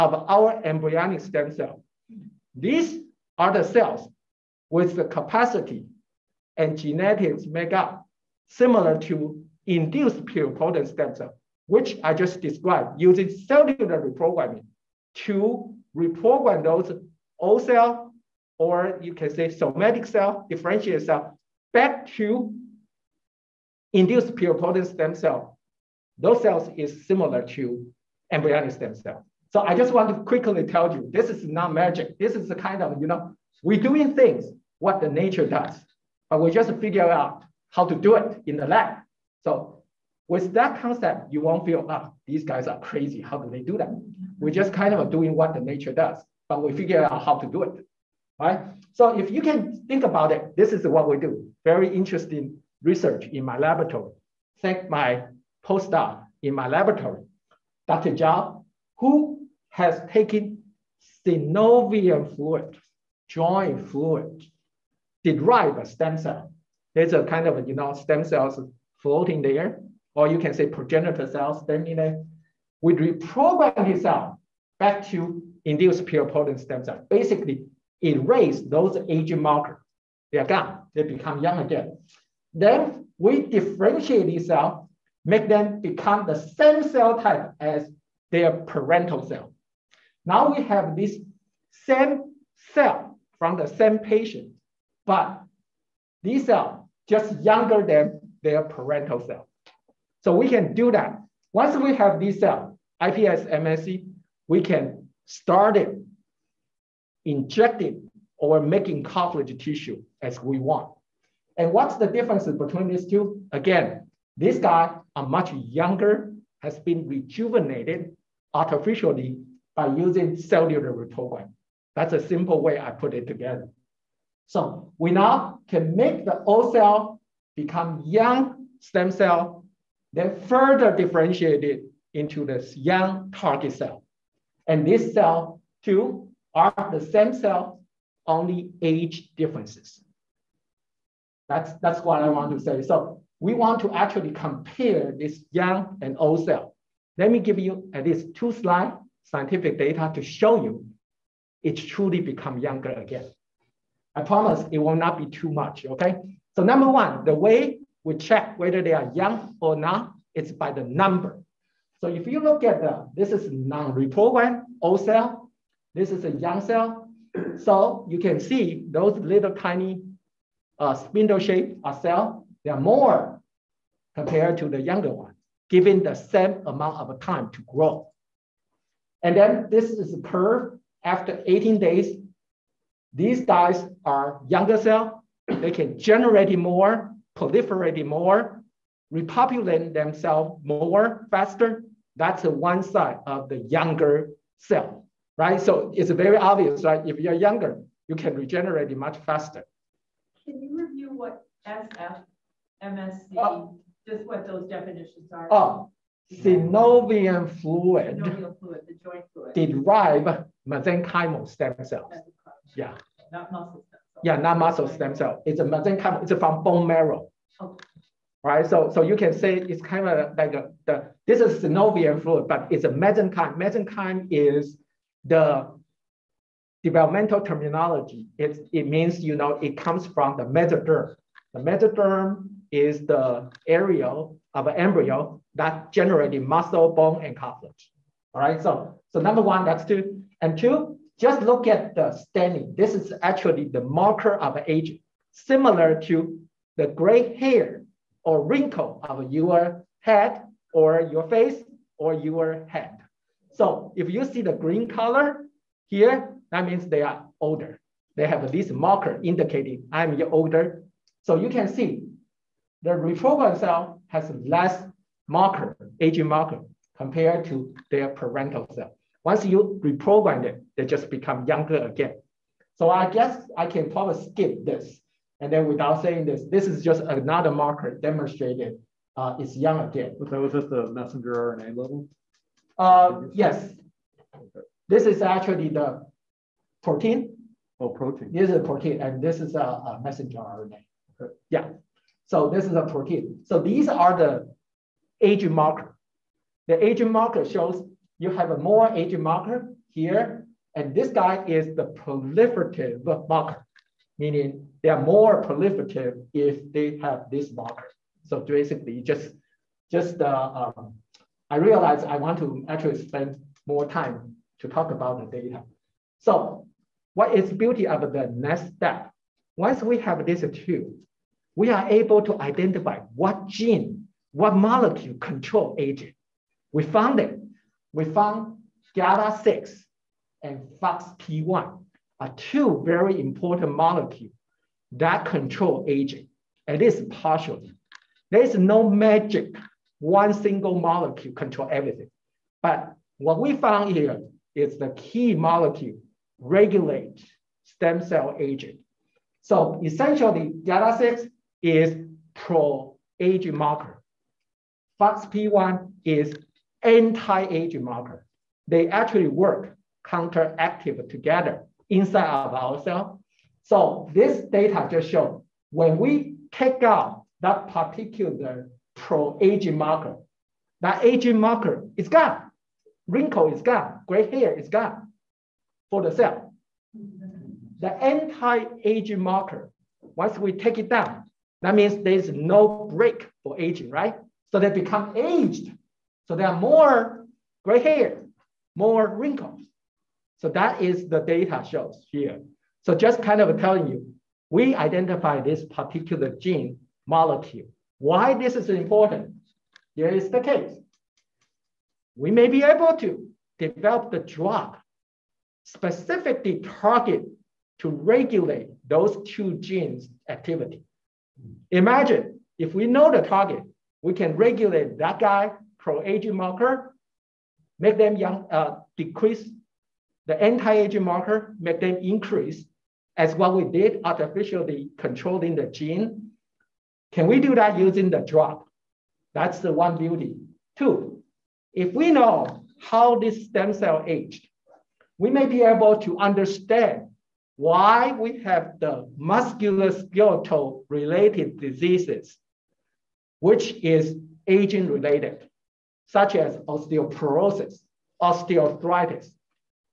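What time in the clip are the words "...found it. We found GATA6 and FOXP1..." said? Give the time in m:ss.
5:26.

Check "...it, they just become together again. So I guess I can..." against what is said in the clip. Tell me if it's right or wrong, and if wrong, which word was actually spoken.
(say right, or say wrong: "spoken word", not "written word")
wrong: "younger", not "together".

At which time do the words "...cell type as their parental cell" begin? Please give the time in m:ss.
1:26.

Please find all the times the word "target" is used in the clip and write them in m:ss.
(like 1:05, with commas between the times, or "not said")
2:13, 6:46, 6:53.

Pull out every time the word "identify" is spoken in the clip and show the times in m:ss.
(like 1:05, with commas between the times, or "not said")
5:22, 6:34.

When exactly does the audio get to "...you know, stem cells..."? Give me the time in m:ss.
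1:07.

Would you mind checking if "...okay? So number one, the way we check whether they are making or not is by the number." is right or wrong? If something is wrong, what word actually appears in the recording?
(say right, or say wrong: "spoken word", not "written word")
wrong: "young", not "making".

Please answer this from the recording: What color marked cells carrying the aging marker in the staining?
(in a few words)
green.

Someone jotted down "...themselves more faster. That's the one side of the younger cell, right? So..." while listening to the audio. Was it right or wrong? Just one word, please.
right.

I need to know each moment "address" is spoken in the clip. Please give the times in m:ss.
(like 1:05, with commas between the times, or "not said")
not said.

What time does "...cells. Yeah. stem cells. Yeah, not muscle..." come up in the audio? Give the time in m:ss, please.
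3:31.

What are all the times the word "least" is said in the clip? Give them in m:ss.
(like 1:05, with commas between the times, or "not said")
2:28, 5:36.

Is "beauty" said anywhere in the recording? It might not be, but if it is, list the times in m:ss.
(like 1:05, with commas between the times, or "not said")
5:17, 7:09.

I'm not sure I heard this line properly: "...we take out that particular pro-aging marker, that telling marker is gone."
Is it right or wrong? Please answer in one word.
wrong.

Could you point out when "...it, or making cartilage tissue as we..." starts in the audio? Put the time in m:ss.
1:47.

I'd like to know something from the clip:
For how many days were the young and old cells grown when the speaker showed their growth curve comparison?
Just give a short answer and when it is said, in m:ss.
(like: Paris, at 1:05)
18, at 3:01.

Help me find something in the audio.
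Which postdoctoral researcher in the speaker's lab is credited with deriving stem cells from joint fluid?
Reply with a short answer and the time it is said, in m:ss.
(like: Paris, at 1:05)
Dr. Zhao, at 0:57.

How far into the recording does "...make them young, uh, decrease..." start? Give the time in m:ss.
6:57.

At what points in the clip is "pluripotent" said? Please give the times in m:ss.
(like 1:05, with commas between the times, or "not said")
0:10, 0:24, 1:16.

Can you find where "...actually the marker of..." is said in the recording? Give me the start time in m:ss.
4:03.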